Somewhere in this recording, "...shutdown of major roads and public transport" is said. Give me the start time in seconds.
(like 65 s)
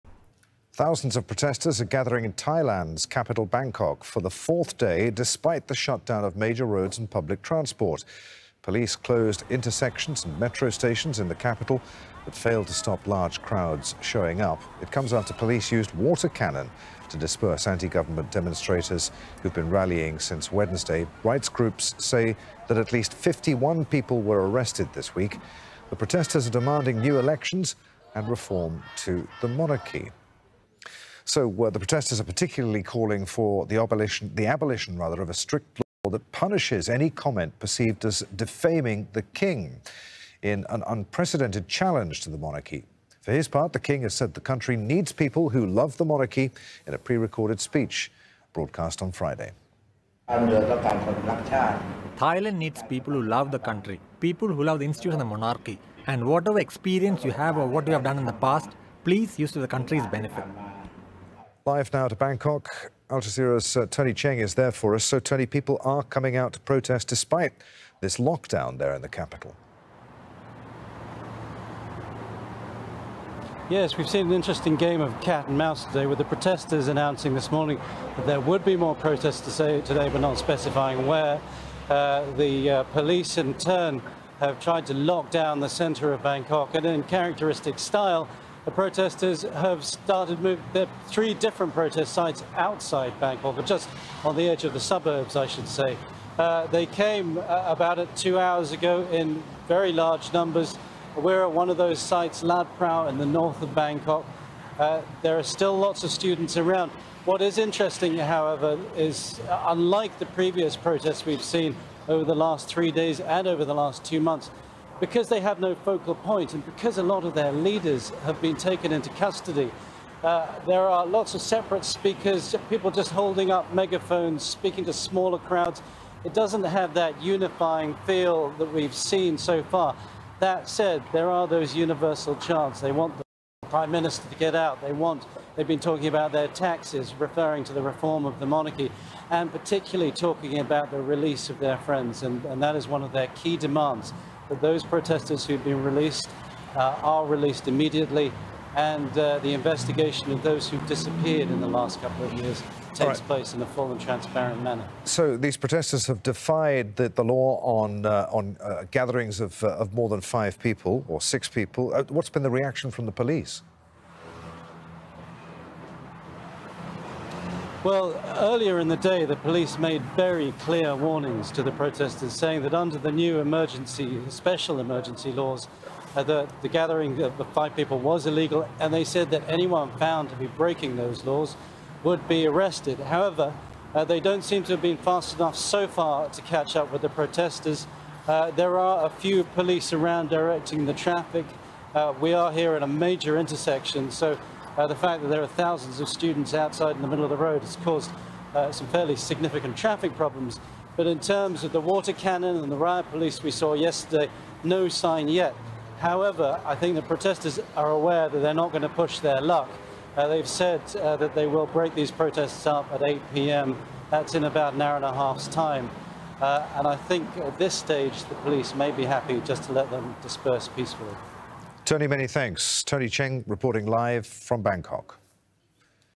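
5 s.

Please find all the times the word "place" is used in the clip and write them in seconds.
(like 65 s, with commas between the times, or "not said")
153 s.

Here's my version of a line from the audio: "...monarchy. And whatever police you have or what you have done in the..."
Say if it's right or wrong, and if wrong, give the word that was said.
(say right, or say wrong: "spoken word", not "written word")
wrong: "experience", not "police".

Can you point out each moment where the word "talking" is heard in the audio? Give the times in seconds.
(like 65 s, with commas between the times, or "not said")
135 s, 140 s.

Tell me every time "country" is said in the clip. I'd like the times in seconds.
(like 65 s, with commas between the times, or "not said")
44 s, 53 s, 59 s.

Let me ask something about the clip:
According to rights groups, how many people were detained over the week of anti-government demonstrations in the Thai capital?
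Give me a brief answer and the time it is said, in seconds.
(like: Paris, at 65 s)
51, at 23 s.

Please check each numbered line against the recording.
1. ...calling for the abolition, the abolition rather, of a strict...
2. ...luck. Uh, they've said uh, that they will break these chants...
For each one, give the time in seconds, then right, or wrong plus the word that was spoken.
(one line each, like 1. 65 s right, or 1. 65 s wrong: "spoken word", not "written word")
1. 32 s right
2. 209 s wrong: "protests", not "chants".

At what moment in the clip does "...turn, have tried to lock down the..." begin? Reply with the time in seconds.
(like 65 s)
83 s.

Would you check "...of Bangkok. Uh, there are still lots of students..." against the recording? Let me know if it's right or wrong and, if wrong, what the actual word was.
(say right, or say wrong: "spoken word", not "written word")
right.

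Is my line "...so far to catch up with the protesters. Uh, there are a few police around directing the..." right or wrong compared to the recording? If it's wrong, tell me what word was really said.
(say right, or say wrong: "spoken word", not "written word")
right.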